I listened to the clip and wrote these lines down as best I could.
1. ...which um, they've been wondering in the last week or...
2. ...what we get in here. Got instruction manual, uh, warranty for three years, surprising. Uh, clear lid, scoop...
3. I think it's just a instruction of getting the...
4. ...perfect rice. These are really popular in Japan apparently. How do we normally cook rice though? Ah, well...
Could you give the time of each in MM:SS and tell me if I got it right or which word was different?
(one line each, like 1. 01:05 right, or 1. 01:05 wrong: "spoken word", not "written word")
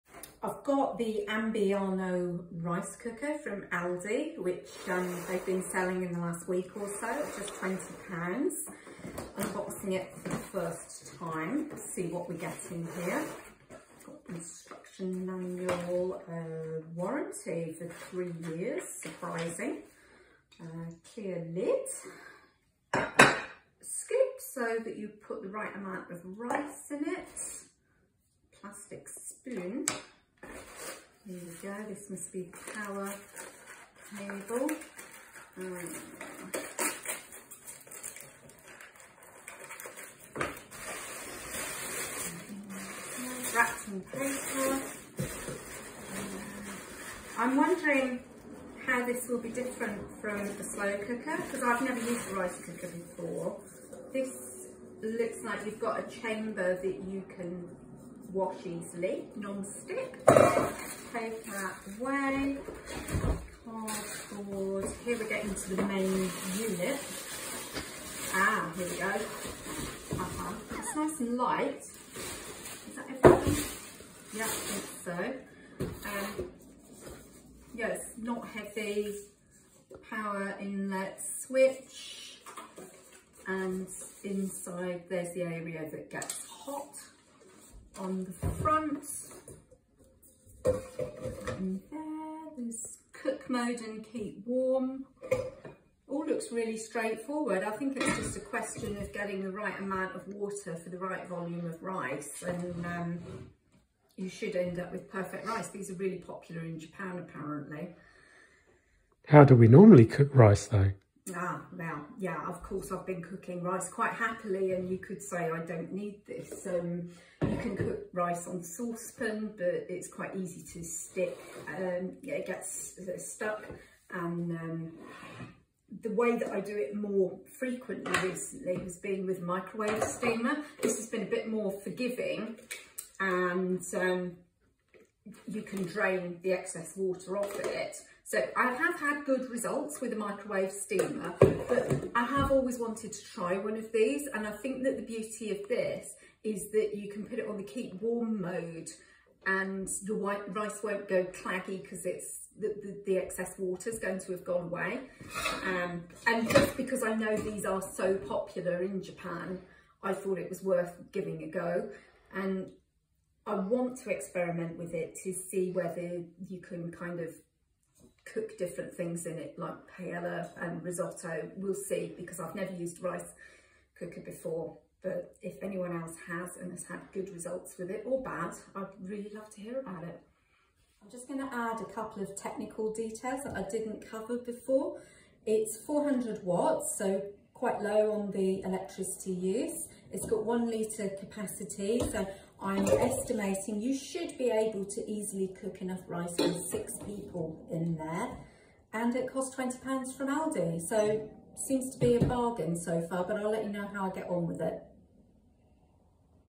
1. 00:04 wrong: "selling", not "wondering"
2. 00:12 right
3. 01:37 wrong: "question", not "instruction"
4. 01:45 right.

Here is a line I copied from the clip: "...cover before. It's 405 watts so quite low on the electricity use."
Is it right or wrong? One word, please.
wrong.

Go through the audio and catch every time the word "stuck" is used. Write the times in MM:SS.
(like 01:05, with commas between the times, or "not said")
02:03.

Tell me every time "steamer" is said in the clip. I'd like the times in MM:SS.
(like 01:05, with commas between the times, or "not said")
02:10, 02:20.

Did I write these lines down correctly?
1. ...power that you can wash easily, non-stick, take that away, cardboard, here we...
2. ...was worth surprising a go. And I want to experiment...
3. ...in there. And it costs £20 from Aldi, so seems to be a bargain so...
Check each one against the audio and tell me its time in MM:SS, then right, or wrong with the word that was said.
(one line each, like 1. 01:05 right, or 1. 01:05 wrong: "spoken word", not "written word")
1. 00:56 wrong: "chamber", not "power"
2. 02:40 wrong: "giving", not "surprising"
3. 03:17 right.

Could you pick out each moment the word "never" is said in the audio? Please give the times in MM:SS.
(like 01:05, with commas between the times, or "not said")
00:51, 02:52.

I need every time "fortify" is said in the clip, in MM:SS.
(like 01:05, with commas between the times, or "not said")
not said.